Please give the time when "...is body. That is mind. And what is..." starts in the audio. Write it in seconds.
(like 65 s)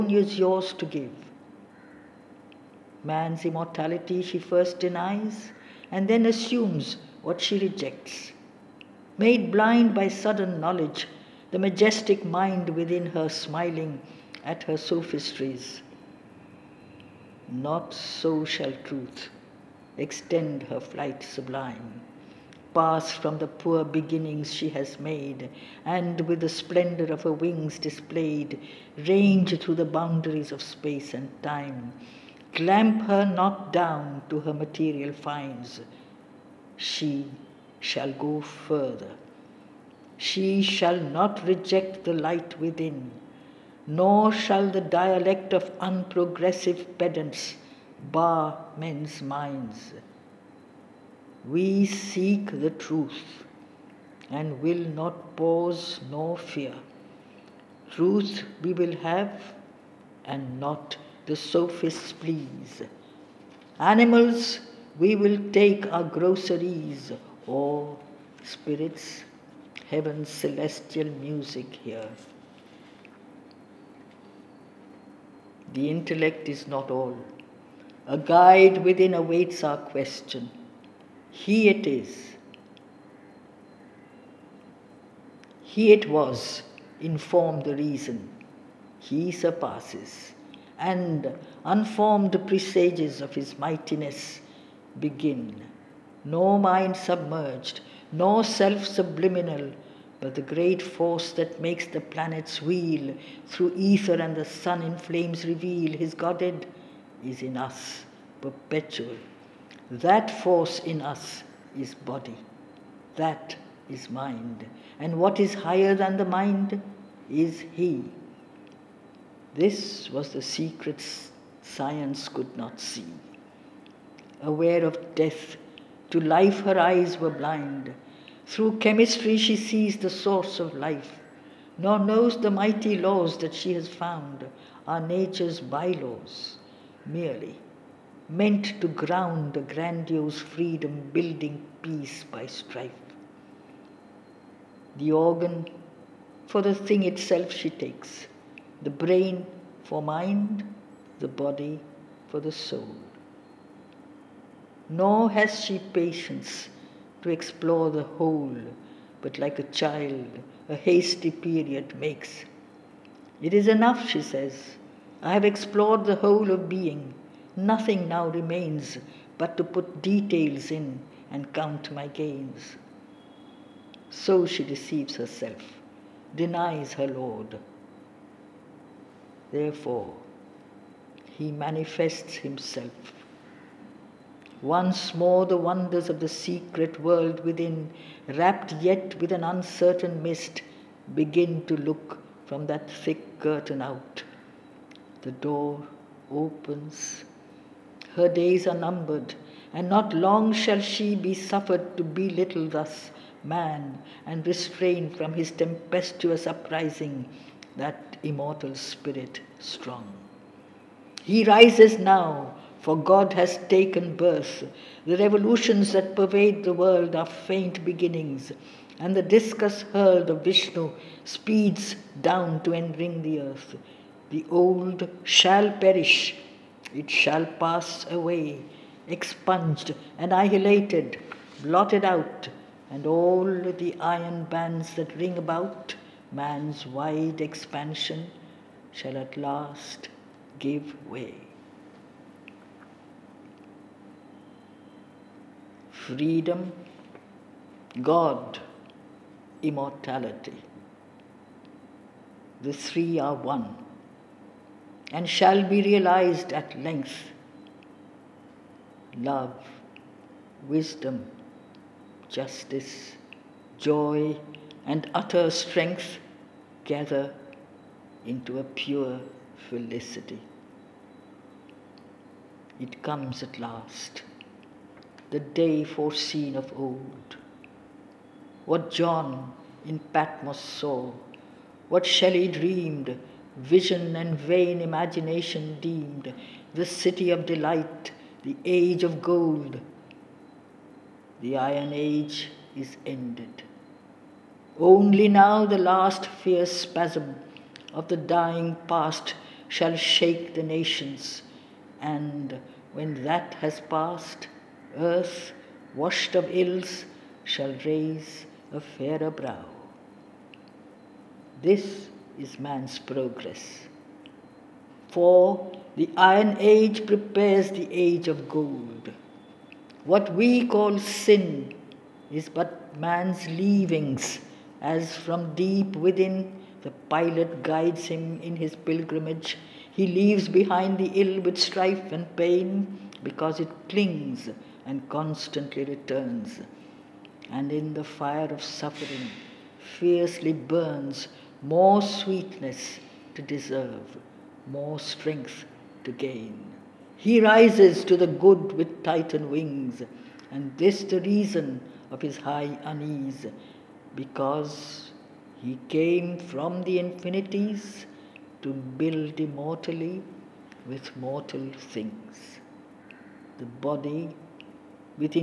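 111 s.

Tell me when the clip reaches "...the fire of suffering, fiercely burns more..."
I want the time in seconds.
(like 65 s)
337 s.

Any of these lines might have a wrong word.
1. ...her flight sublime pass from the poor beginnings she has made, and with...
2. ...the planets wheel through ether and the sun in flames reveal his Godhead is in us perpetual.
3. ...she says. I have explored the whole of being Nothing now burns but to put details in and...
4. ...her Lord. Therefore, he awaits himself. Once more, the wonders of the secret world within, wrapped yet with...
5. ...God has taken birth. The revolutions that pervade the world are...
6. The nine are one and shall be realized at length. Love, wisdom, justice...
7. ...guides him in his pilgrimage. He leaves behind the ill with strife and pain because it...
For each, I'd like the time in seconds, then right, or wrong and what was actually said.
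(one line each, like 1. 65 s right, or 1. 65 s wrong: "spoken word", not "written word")
1. 20 s right
2. 101 s right
3. 164 s wrong: "remains", not "burns"
4. 176 s wrong: "manifests", not "awaits"
5. 212 s right
6. 252 s wrong: "three", not "nine"
7. 327 s right.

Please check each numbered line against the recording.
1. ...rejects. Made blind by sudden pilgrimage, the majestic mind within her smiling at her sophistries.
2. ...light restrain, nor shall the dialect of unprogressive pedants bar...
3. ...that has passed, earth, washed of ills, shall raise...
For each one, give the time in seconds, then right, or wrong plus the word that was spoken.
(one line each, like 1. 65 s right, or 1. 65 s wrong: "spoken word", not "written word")
1. 7 s wrong: "knowledge", not "pilgrimage"
2. 42 s wrong: "within", not "restrain"
3. 303 s right.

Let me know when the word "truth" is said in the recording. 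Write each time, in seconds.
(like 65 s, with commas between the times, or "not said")
18 s, 52 s, 57 s.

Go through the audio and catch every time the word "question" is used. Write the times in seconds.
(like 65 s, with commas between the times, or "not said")
79 s.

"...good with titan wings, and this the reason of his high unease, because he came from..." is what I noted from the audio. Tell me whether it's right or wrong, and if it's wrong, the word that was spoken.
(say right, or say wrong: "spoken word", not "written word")
right.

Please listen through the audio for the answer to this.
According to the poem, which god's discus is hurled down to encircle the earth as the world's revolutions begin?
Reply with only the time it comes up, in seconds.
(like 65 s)
220 s.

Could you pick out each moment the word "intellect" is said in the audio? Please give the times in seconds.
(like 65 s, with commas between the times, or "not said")
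75 s.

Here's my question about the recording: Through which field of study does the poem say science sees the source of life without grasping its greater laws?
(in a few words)
Chemistry.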